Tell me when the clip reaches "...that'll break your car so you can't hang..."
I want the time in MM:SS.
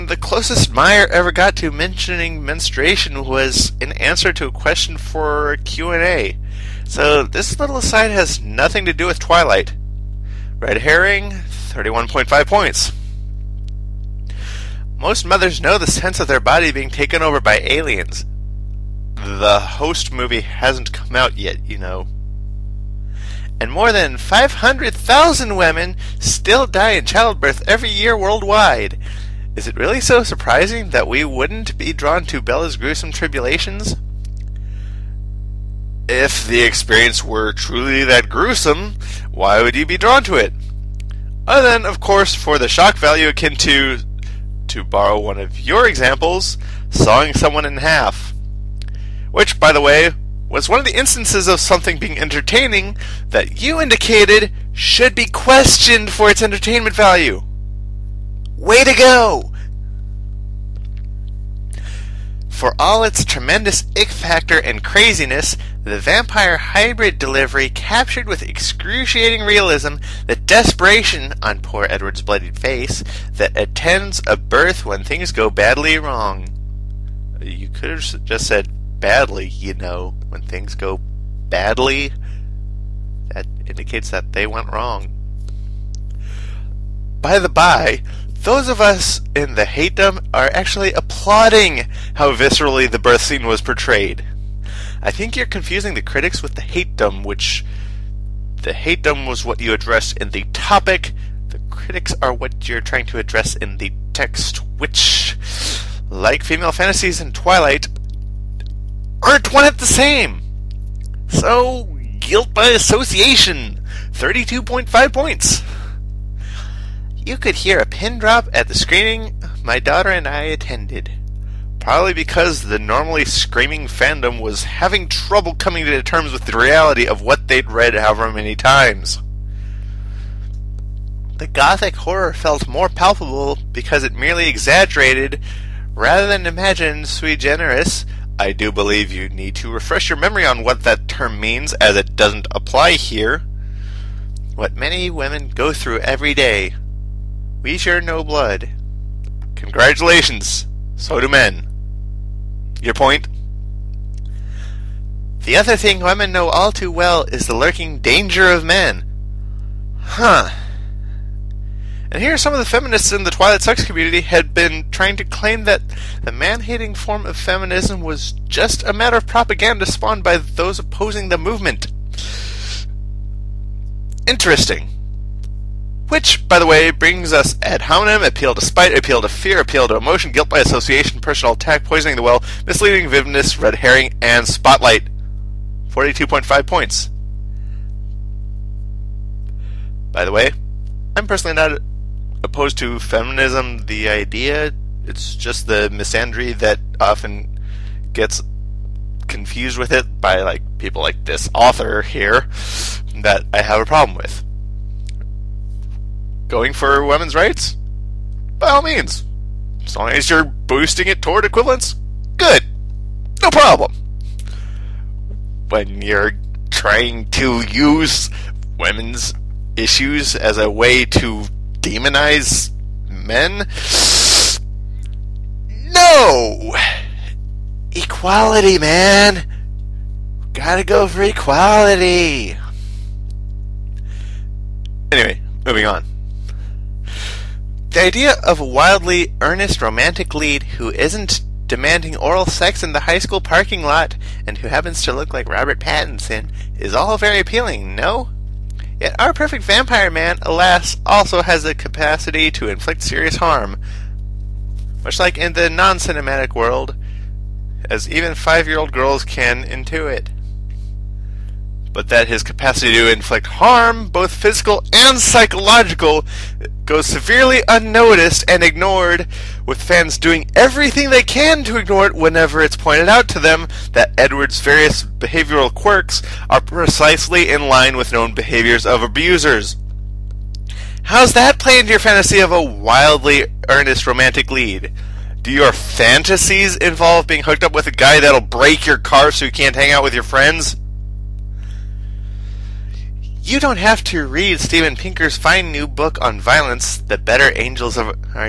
04:48.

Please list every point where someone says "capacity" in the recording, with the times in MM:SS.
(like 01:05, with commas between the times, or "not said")
04:11, 04:22.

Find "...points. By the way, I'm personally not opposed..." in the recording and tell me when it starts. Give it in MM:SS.
03:06.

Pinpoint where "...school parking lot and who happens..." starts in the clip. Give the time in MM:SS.
04:03.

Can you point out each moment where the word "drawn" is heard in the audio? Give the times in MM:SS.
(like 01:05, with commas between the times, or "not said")
00:31, 00:39.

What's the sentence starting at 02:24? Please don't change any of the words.
What many women go through every day.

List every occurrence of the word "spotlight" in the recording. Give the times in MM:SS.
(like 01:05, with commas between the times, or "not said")
03:04.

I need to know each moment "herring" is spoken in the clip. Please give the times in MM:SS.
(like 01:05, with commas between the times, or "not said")
00:10, 03:03.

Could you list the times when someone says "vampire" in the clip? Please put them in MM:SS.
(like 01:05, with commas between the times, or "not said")
01:05, 04:09.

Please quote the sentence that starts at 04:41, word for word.
How's that play into your fantasy of a wildly earnest romantic lead?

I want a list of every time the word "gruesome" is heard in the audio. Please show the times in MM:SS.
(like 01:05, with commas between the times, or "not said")
00:32, 00:38.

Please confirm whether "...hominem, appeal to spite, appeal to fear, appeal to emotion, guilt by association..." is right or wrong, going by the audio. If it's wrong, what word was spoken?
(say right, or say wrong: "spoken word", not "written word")
right.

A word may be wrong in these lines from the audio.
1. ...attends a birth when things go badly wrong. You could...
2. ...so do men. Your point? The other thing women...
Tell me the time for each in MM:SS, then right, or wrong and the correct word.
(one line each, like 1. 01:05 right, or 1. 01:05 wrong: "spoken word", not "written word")
1. 01:13 right
2. 02:30 right.